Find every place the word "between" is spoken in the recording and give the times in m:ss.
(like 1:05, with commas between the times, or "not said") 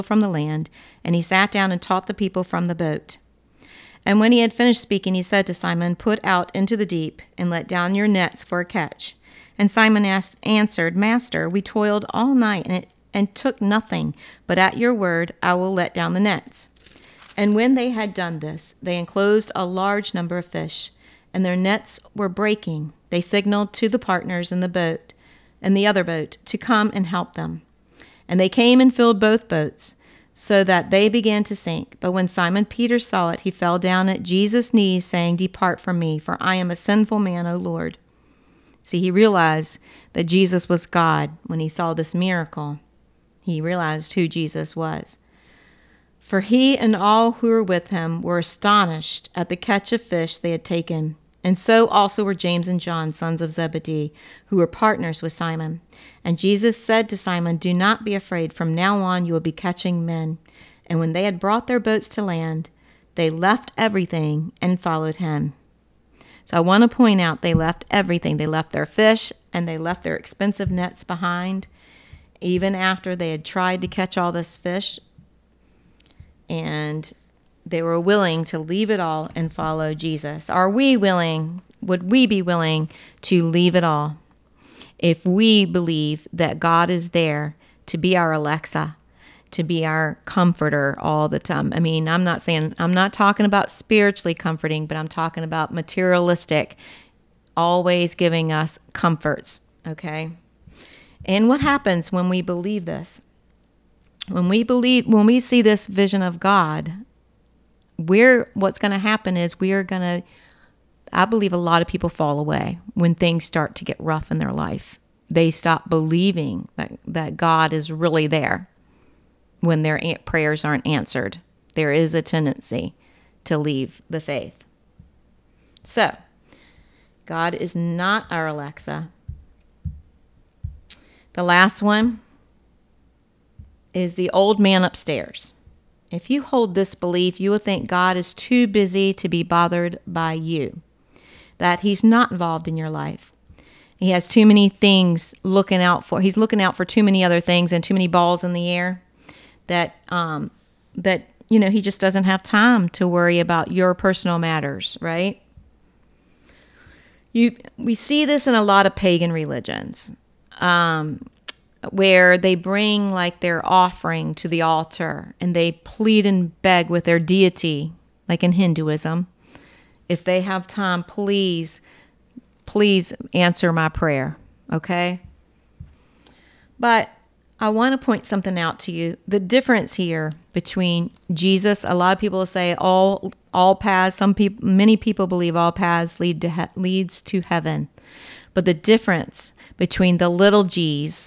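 3:00, 3:09.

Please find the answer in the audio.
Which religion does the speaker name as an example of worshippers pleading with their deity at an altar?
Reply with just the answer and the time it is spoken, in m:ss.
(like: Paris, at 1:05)
Hinduism, at 2:48.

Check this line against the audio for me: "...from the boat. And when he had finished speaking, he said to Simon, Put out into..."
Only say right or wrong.
right.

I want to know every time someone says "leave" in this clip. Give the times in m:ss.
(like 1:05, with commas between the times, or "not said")
1:18, 1:23, 2:03.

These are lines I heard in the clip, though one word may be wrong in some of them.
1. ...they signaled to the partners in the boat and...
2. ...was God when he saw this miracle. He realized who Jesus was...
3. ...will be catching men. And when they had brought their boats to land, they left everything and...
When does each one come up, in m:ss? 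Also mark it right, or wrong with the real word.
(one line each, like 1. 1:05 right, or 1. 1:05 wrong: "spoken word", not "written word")
1. 0:23 right
2. 0:40 right
3. 0:59 right.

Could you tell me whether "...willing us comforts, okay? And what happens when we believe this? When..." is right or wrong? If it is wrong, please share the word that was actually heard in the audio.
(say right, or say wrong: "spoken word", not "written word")
wrong: "giving", not "willing".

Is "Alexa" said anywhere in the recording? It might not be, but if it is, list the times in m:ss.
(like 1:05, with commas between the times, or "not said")
1:28, 2:08.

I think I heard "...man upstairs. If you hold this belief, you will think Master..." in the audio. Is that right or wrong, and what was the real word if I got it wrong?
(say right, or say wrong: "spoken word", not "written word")
wrong: "God", not "Master".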